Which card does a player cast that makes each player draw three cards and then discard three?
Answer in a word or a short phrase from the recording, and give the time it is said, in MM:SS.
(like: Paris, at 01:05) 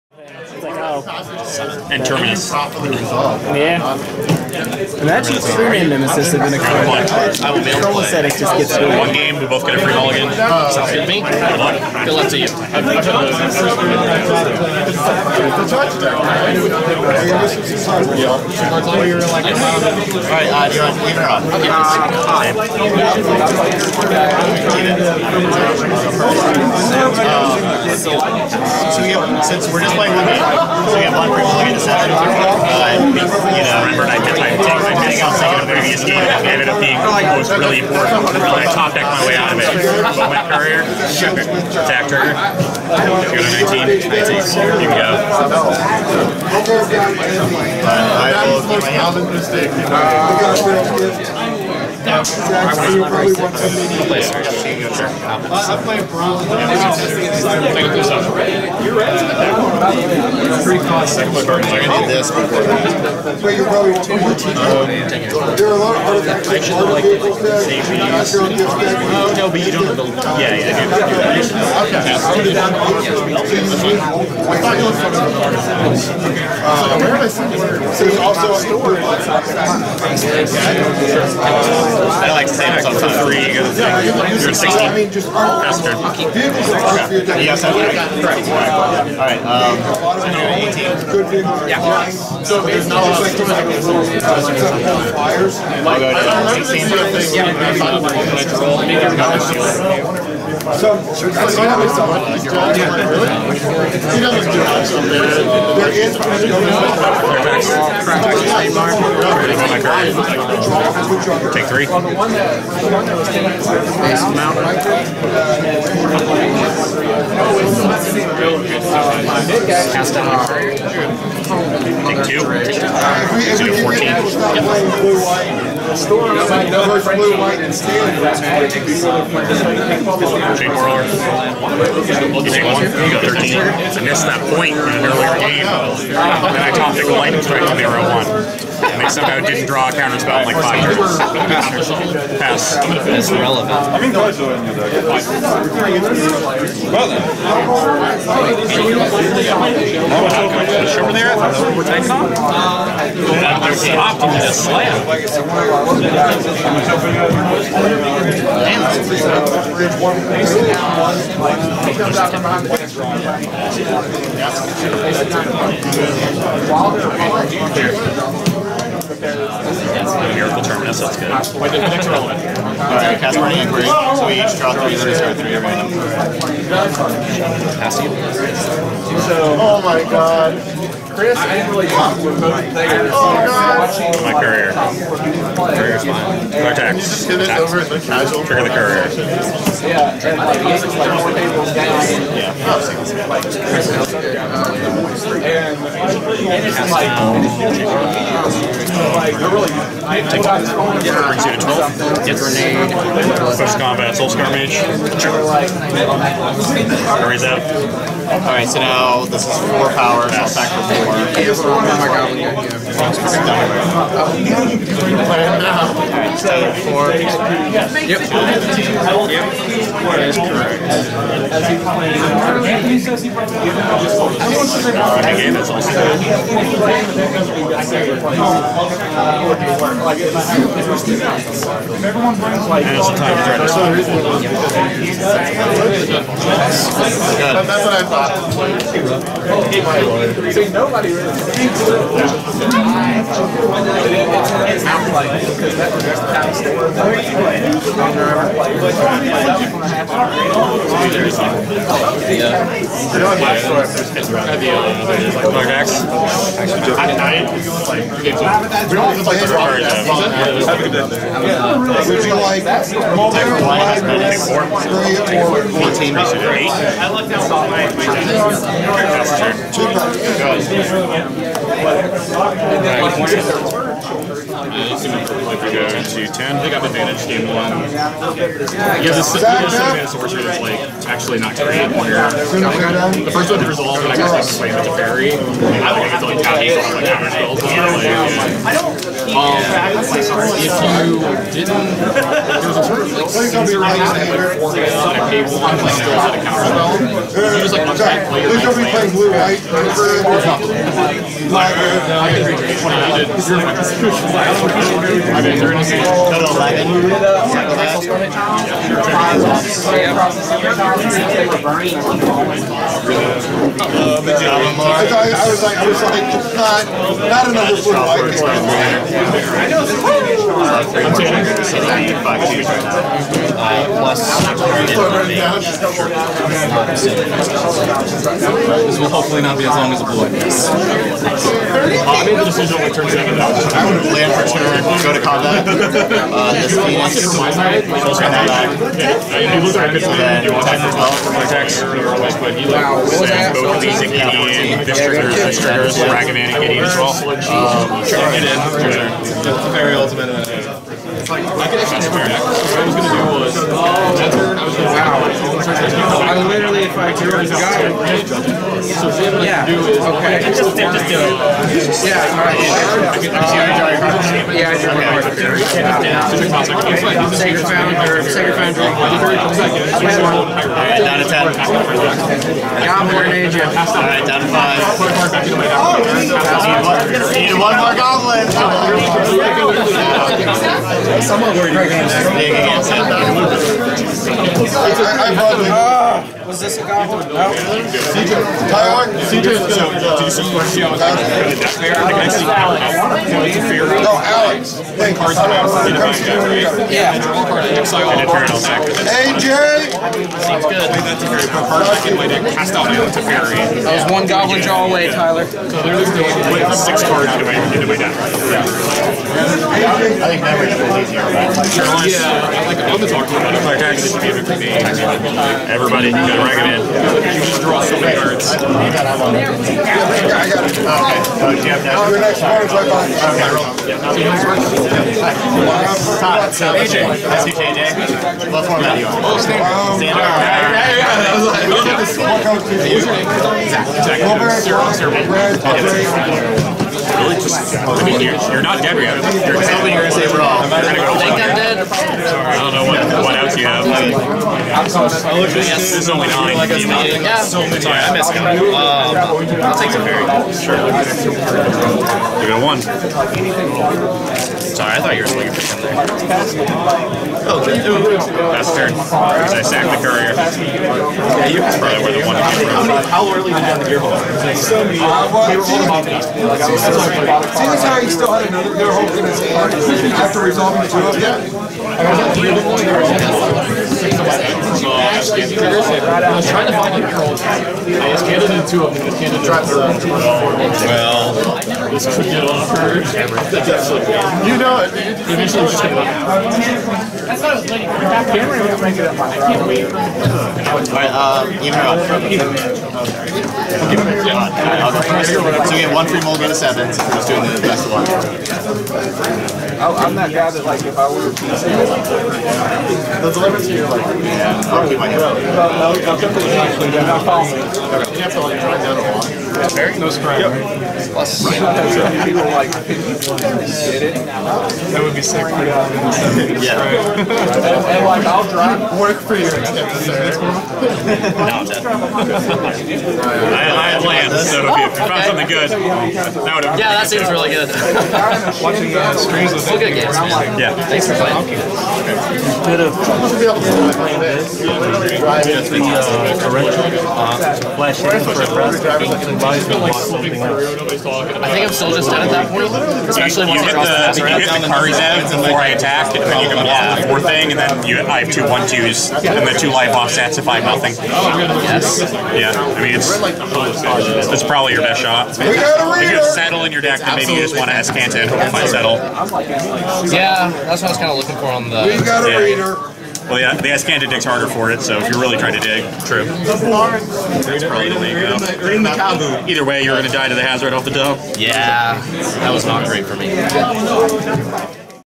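Burning Inquiry, at 02:53.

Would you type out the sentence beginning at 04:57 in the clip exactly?
you just like unpack player like playing blue, right?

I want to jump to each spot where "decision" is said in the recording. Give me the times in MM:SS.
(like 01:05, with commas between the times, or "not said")
05:32.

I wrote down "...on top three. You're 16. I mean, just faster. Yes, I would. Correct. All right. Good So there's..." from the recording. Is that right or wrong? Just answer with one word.
right.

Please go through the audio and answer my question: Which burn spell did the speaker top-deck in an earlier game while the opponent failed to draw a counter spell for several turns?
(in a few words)
Lightning Strike.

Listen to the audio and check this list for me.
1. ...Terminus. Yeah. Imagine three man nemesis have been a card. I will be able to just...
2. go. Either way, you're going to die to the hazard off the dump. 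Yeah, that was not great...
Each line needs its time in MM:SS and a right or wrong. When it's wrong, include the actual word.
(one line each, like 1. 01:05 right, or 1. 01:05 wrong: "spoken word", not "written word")
1. 00:02 right
2. 09:28 right.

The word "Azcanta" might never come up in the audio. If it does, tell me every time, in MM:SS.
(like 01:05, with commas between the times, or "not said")
09:17, 09:23.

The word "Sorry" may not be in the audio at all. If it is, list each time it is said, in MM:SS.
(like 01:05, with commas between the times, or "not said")
07:27, 07:34.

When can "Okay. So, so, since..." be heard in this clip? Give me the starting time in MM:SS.
00:27.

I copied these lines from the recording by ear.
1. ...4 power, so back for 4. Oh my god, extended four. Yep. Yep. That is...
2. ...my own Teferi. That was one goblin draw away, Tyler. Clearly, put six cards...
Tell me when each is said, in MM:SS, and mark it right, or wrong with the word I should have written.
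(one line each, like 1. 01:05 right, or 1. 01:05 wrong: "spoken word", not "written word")
1. 03:29 right
2. 06:42 right.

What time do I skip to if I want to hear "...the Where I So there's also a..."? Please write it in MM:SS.
01:15.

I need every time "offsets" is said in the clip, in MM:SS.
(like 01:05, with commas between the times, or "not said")
09:09.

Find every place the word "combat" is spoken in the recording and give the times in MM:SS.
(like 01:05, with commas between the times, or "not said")
03:23, 05:35.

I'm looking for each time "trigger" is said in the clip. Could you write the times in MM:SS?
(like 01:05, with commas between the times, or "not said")
00:42, 03:08, 05:44.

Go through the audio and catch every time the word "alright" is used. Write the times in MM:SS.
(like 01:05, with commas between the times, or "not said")
00:12, 02:52, 03:28, 06:02, 06:08, 06:13, 08:10.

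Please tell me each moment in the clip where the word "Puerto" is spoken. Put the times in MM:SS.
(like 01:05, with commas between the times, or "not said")
not said.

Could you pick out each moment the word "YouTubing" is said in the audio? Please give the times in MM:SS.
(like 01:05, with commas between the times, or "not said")
not said.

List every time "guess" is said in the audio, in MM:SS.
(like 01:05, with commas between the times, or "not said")
04:44.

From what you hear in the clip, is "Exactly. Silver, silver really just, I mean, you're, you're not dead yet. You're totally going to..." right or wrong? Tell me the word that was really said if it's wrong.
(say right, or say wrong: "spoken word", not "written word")
right.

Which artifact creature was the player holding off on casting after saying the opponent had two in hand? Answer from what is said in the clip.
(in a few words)
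Gearhulk.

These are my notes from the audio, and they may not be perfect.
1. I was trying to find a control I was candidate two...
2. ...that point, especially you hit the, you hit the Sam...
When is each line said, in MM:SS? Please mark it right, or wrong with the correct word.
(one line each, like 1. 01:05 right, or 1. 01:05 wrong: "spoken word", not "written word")
1. 07:54 right
2. 09:02 wrong: "Kari", not "Sam".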